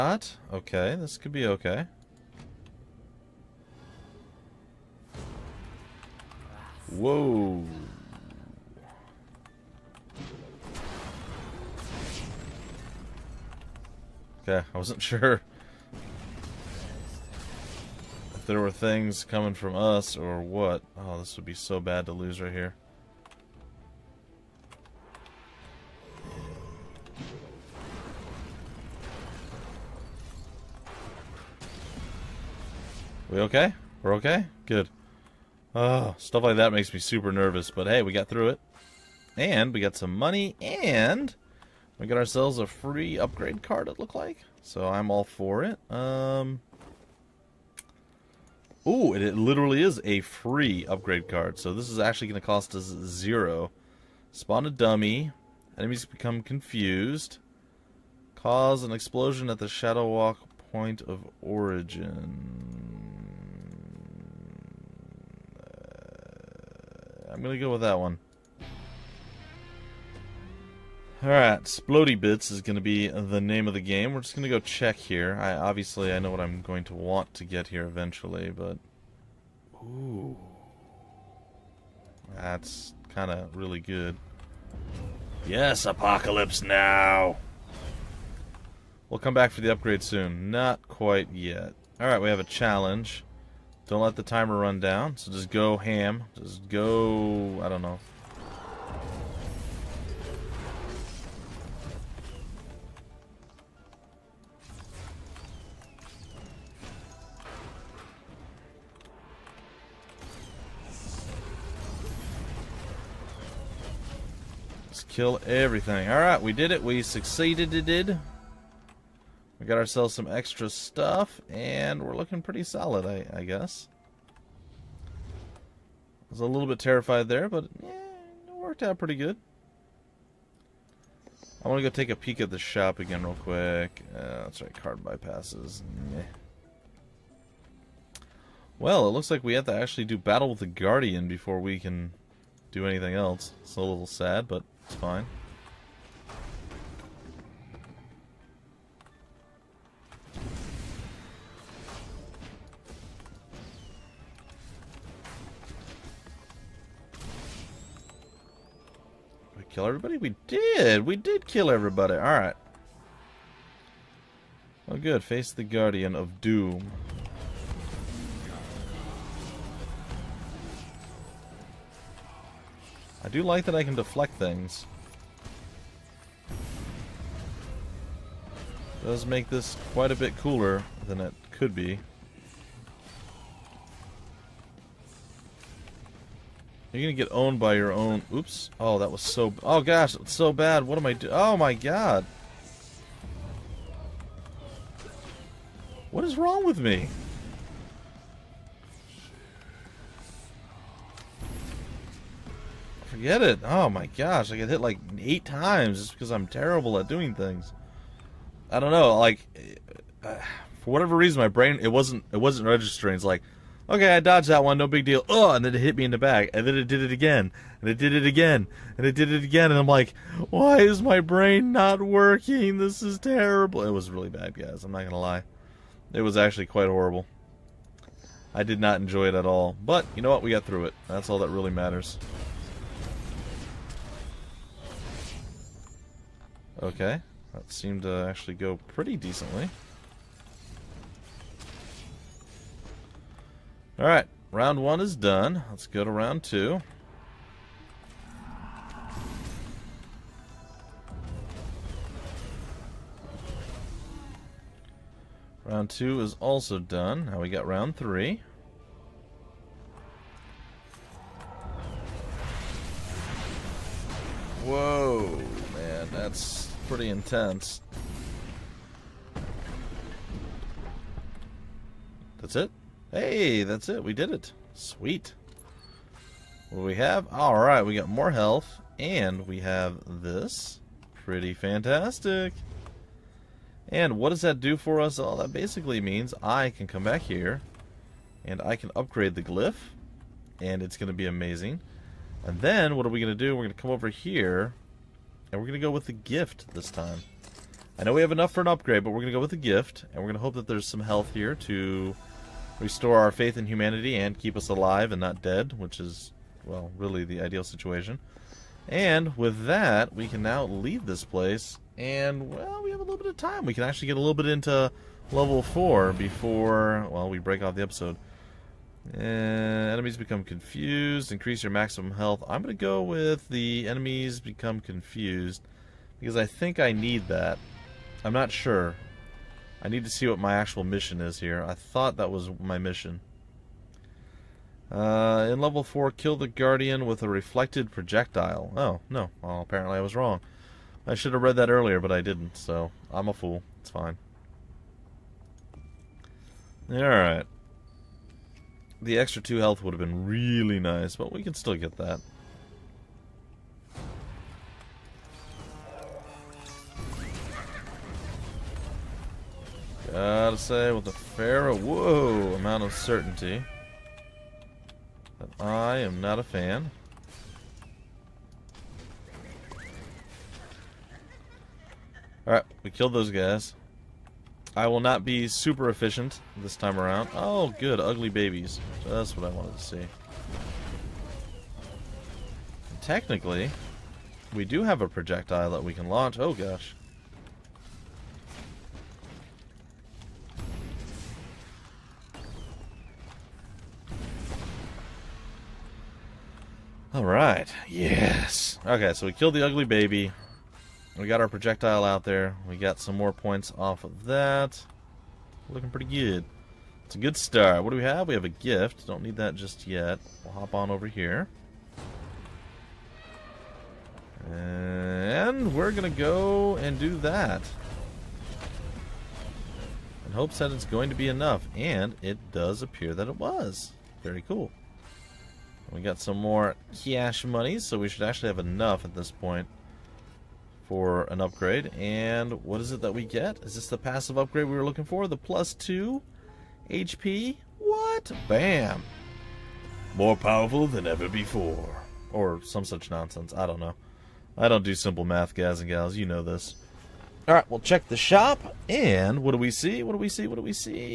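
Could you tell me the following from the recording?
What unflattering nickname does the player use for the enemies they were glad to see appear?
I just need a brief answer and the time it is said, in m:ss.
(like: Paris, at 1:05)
Ugly babies, at 6:18.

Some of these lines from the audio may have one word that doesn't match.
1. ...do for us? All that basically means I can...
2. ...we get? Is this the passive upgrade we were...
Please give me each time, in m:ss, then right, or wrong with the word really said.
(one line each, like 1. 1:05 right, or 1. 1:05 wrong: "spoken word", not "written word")
1. 4:44 right
2. 7:13 right.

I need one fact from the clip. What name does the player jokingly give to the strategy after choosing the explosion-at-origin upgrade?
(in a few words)
Splody Bits.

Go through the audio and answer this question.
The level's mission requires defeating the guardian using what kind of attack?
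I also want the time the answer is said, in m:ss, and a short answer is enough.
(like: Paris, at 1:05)
A reflected projectile, at 5:37.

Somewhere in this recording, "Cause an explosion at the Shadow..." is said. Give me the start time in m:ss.
0:58.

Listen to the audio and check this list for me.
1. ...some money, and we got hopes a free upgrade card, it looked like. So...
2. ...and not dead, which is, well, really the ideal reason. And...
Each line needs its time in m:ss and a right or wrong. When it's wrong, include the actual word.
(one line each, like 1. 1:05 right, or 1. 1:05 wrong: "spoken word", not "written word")
1. 0:39 wrong: "ourselves", not "hopes"
2. 5:05 wrong: "situation", not "reason".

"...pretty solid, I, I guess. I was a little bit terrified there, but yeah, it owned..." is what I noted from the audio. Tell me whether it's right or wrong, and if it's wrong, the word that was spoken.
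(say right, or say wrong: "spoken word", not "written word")
wrong: "worked", not "owned".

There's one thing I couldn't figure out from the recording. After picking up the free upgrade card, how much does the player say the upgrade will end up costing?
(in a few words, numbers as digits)
0.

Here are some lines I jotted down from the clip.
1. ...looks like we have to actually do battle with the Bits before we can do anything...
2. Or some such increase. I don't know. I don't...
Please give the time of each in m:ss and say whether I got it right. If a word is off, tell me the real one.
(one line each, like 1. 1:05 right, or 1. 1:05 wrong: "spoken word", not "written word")
1. 2:19 wrong: "Guardian", not "Bits"
2. 7:22 wrong: "nonsense", not "increase".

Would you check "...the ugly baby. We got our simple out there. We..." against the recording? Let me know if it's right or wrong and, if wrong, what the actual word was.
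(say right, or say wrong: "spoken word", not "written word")
wrong: "projectile", not "simple".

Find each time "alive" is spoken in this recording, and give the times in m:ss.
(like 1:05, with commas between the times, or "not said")
5:04.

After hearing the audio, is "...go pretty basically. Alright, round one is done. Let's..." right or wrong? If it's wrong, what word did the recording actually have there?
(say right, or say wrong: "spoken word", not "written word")
wrong: "decently", not "basically".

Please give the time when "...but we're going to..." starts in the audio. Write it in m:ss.
4:59.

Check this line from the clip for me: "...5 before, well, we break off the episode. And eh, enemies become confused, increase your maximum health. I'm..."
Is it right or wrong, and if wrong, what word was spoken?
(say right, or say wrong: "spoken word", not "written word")
wrong: "4", not "5".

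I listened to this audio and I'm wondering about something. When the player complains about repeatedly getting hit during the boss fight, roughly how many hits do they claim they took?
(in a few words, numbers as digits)
8.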